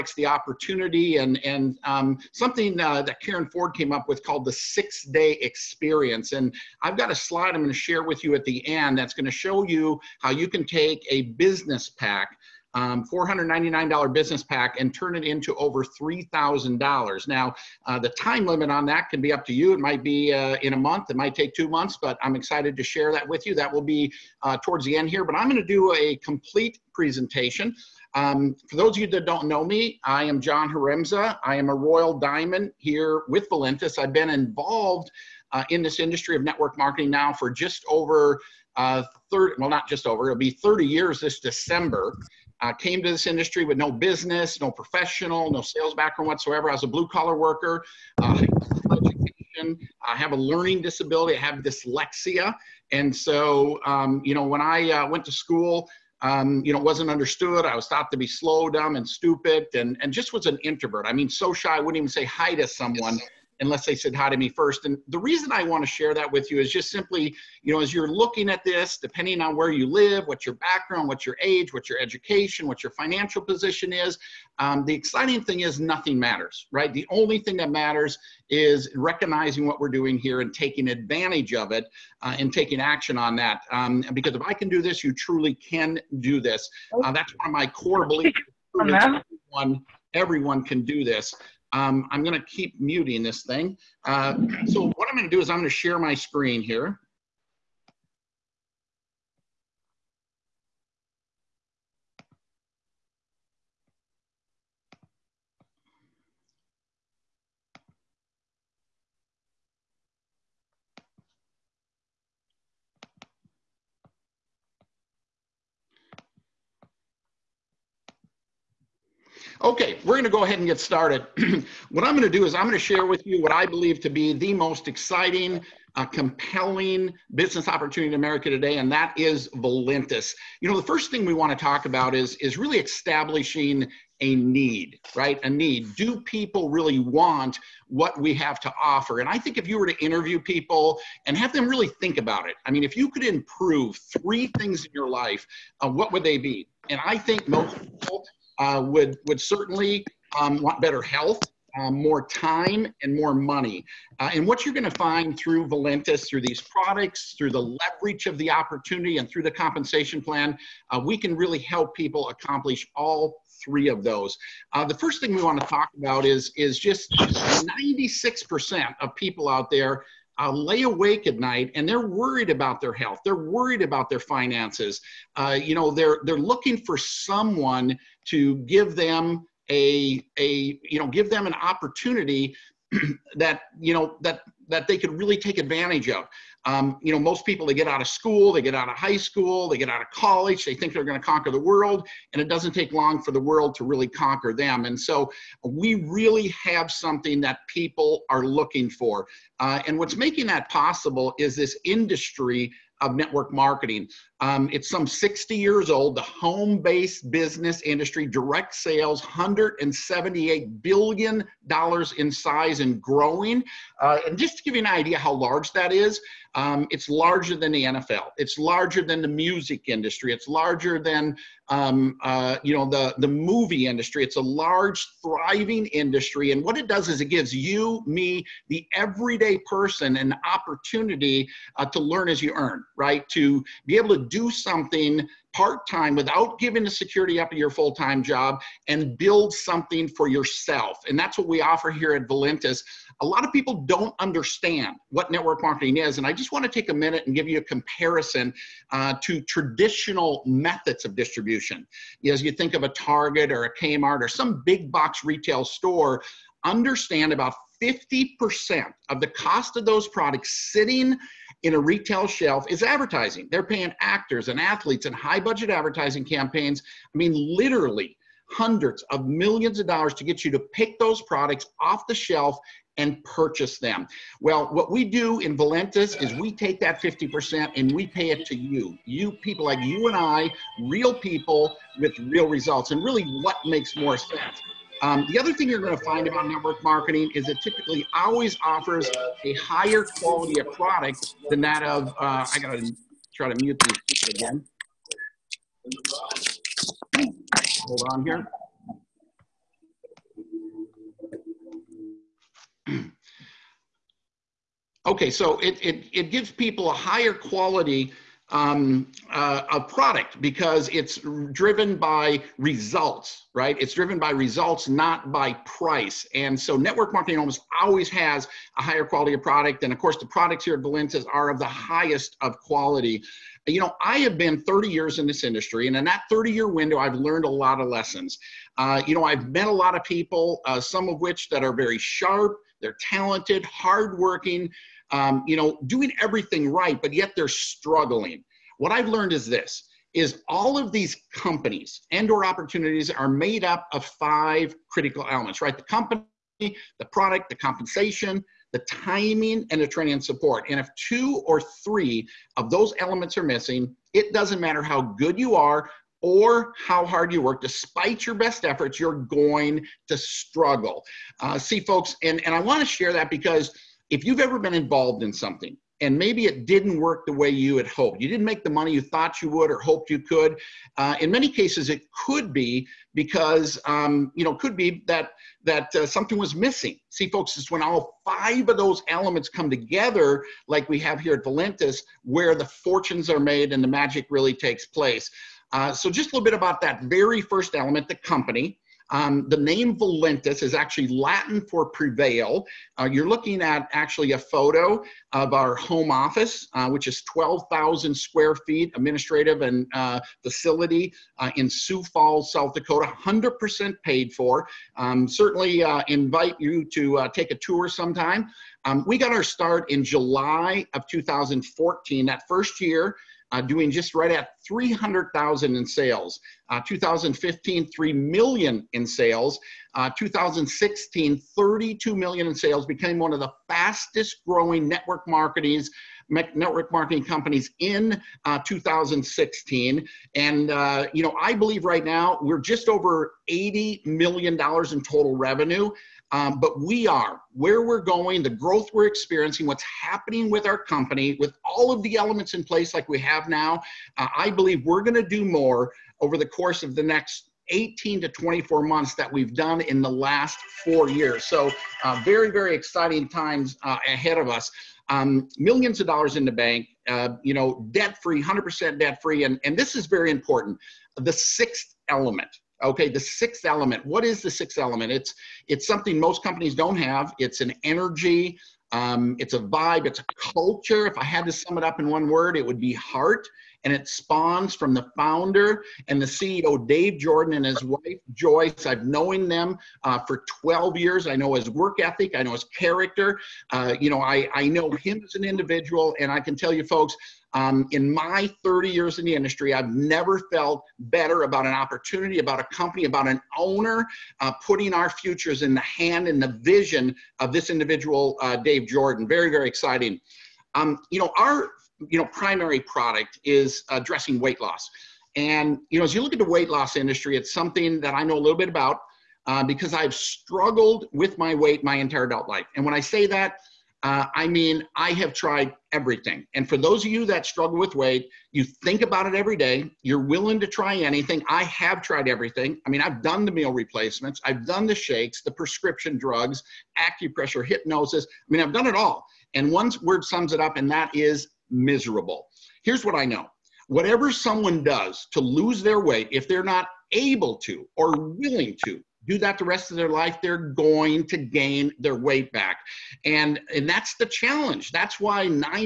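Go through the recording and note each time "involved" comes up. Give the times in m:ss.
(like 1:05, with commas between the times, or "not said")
0:34, 6:04.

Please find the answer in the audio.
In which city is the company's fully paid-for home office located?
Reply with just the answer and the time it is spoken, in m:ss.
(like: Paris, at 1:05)
Sioux Falls, at 6:41.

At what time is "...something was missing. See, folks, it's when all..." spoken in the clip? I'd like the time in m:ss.
6:16.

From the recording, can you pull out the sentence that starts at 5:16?
And so network marketing almost always has a higher quality of product.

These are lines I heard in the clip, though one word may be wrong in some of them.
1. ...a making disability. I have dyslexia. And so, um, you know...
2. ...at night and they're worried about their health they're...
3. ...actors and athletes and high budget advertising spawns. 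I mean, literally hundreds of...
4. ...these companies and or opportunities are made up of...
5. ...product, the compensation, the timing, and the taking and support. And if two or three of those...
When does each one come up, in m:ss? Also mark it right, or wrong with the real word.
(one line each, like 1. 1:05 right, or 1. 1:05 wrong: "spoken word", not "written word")
1. 0:50 wrong: "learning", not "making"
2. 2:51 right
3. 4:24 wrong: "campaigns", not "spawns"
4. 5:40 right
5. 5:47 wrong: "training", not "taking".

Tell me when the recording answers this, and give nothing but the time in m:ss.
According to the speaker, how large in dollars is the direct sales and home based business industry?
3:29.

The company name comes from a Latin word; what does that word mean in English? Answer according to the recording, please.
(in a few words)
prevail.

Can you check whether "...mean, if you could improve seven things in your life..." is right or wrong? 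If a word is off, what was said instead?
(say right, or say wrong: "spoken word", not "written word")
wrong: "three", not "seven".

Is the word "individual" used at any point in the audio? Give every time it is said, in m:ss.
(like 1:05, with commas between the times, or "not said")
8:05, 8:17.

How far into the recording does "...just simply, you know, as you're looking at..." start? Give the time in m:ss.
1:06.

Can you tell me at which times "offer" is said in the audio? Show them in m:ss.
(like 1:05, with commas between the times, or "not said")
2:18, 4:01, 4:48.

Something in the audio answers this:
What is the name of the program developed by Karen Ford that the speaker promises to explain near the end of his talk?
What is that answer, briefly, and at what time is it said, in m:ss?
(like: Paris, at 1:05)
six day experience, at 0:04.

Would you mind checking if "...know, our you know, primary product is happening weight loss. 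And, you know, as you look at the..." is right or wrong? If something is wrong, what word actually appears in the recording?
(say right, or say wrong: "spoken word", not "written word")
wrong: "addressing", not "happening".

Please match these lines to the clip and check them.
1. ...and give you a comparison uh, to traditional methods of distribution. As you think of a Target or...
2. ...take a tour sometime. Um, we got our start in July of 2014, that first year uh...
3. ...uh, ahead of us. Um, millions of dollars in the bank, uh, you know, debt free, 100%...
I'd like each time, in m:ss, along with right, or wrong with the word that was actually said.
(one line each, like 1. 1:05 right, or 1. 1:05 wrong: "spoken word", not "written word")
1. 4:07 right
2. 6:47 right
3. 7:33 right.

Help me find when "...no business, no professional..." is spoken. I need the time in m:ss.
0:43.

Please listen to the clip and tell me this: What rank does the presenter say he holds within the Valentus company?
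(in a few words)
Royal Diamond.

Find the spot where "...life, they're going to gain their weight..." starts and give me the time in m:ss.
9:00.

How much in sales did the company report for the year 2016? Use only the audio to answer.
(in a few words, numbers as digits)
32 million.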